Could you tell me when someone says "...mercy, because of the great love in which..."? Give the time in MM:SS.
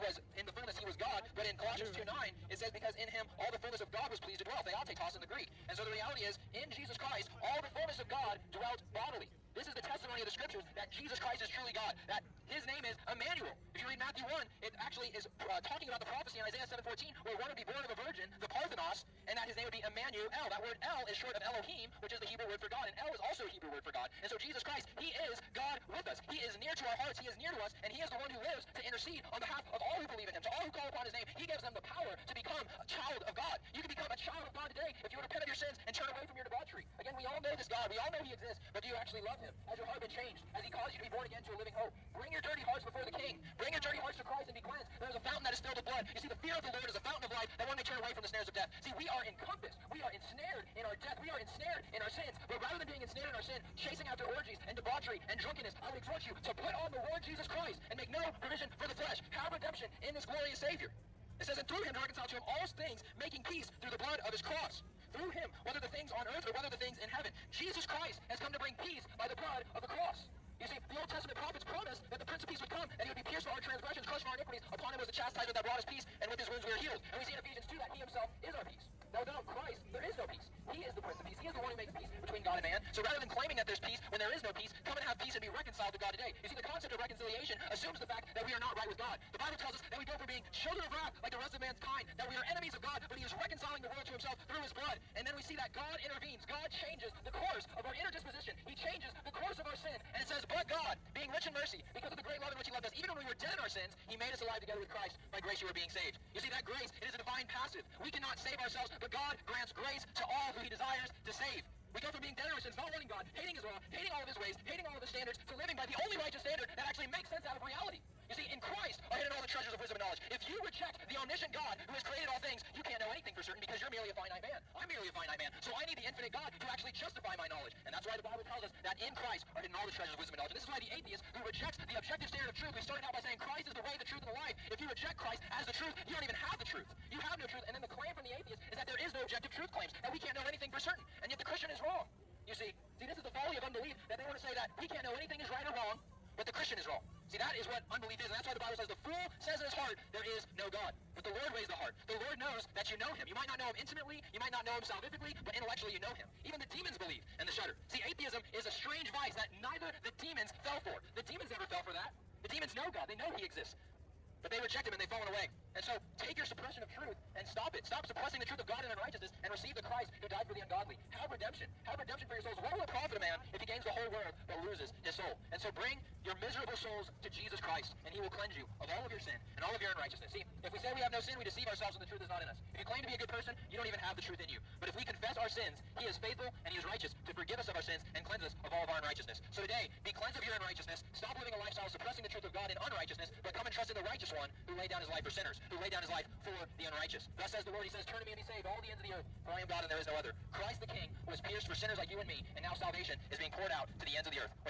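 01:41.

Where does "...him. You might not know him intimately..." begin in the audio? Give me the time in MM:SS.
02:33.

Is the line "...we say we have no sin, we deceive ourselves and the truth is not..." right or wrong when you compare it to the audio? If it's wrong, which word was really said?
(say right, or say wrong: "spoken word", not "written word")
right.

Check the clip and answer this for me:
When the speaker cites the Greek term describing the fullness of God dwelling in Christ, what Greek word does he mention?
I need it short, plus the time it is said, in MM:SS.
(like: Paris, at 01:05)
Theotetos, at 00:04.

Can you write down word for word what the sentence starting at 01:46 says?
You see, that grace, it is a divine passive.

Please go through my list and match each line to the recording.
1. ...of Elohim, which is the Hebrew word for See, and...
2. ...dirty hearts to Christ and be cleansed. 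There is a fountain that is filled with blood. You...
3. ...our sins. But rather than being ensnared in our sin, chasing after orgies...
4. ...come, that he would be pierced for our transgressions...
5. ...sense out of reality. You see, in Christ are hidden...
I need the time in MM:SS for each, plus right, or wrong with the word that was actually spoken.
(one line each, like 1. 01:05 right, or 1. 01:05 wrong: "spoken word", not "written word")
1. 00:21 wrong: "God", not "See"
2. 00:43 right
3. 00:52 right
4. 01:12 right
5. 01:57 right.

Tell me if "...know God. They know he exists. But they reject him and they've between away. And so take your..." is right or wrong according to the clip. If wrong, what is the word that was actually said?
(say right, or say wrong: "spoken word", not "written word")
wrong: "fallen", not "between".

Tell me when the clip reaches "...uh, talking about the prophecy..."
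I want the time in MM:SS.
00:15.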